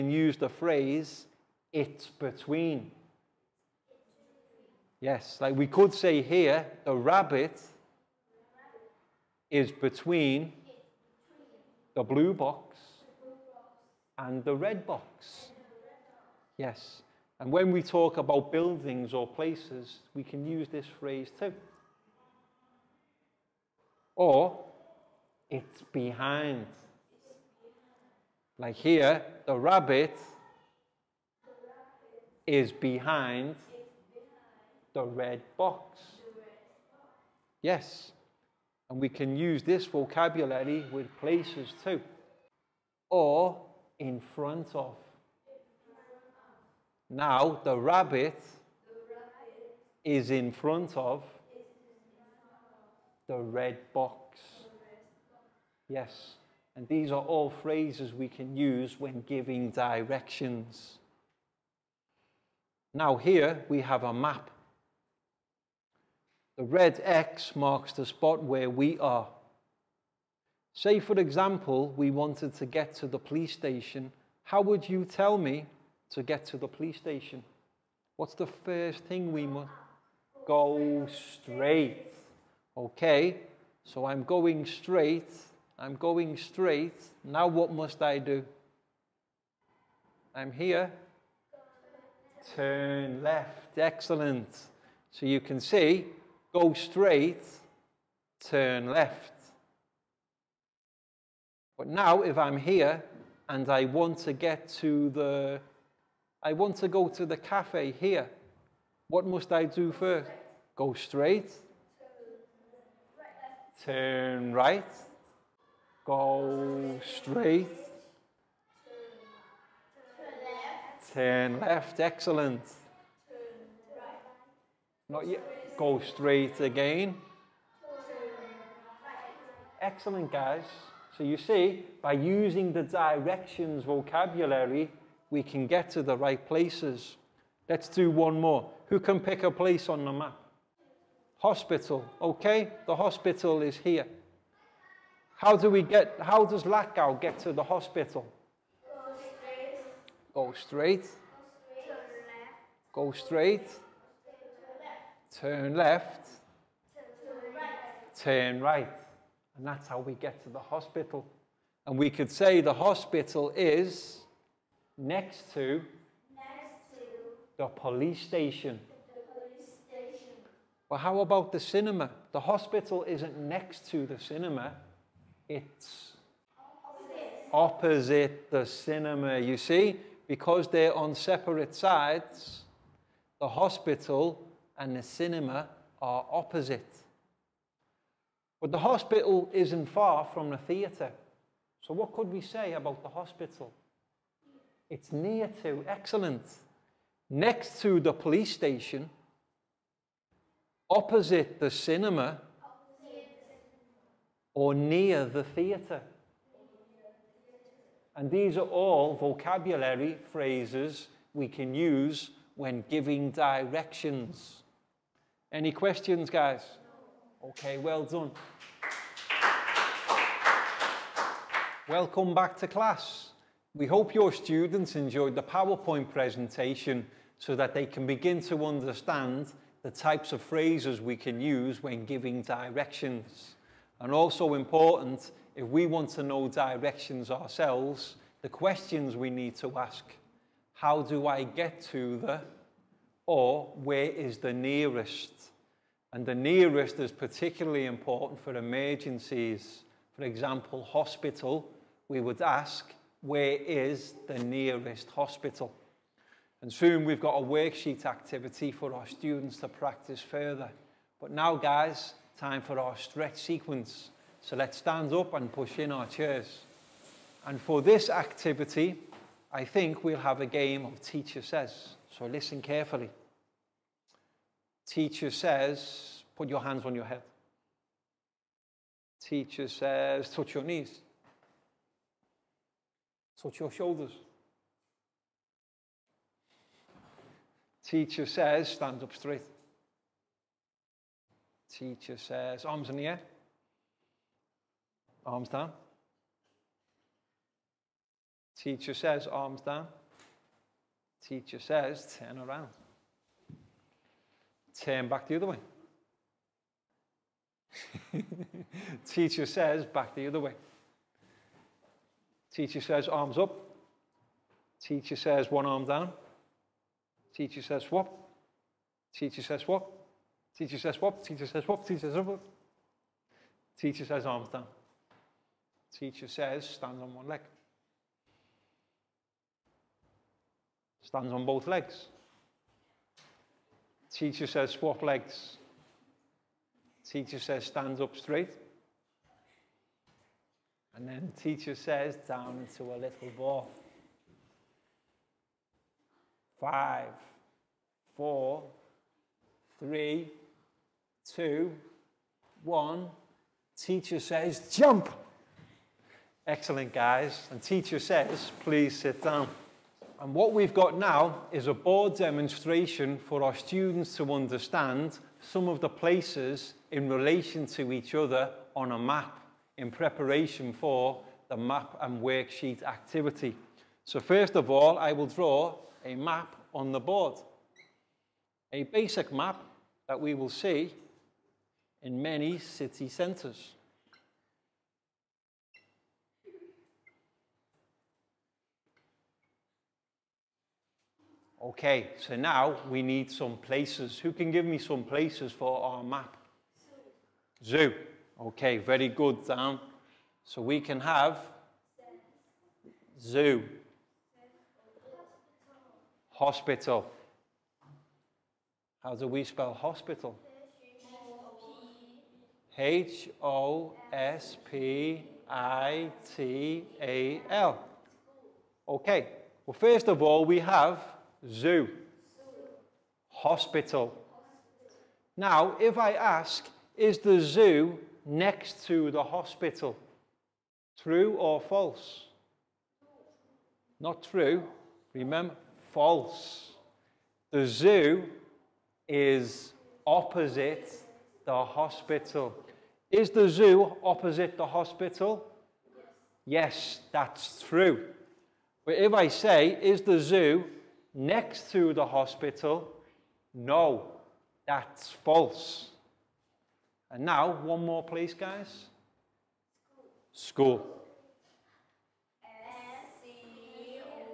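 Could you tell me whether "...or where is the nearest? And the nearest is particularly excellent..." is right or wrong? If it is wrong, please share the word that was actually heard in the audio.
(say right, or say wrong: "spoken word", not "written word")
wrong: "important", not "excellent".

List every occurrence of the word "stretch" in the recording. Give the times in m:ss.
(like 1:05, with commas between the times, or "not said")
4:22.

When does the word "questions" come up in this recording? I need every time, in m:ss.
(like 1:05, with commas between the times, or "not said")
3:35, 3:58.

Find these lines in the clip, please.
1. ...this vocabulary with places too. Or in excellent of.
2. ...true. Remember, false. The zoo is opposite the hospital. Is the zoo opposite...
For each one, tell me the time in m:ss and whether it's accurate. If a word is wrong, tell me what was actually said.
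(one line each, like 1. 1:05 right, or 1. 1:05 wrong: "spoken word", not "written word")
1. 0:39 wrong: "front", not "excellent"
2. 7:14 right.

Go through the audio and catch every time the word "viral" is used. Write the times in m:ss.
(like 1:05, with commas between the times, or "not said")
not said.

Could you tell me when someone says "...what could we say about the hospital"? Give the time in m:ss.
3:11.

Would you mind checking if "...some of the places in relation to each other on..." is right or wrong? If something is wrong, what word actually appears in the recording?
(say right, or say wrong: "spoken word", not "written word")
right.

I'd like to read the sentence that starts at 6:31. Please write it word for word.
Okay, so now we need some places.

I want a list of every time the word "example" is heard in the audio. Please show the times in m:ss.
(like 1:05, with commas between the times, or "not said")
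1:11, 4:10.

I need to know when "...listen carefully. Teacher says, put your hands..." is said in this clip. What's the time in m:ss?
4:32.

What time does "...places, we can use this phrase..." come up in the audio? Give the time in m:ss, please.
0:19.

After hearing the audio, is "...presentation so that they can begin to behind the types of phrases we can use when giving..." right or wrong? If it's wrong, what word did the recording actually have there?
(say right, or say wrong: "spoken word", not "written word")
wrong: "understand", not "behind".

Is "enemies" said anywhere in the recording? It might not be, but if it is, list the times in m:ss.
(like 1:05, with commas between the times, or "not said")
not said.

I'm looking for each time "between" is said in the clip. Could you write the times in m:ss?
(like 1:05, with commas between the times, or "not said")
0:02, 0:09.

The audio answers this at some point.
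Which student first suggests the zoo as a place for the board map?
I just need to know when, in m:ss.
6:39.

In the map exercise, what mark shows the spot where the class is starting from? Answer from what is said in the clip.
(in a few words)
red X.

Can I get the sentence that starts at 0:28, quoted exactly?
Like here, the rabbit is behind the red box.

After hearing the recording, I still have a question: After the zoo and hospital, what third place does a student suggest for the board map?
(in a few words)
School.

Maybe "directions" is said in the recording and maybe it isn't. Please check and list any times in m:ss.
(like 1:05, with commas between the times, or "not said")
0:59, 2:12, 3:33, 3:52, 3:56.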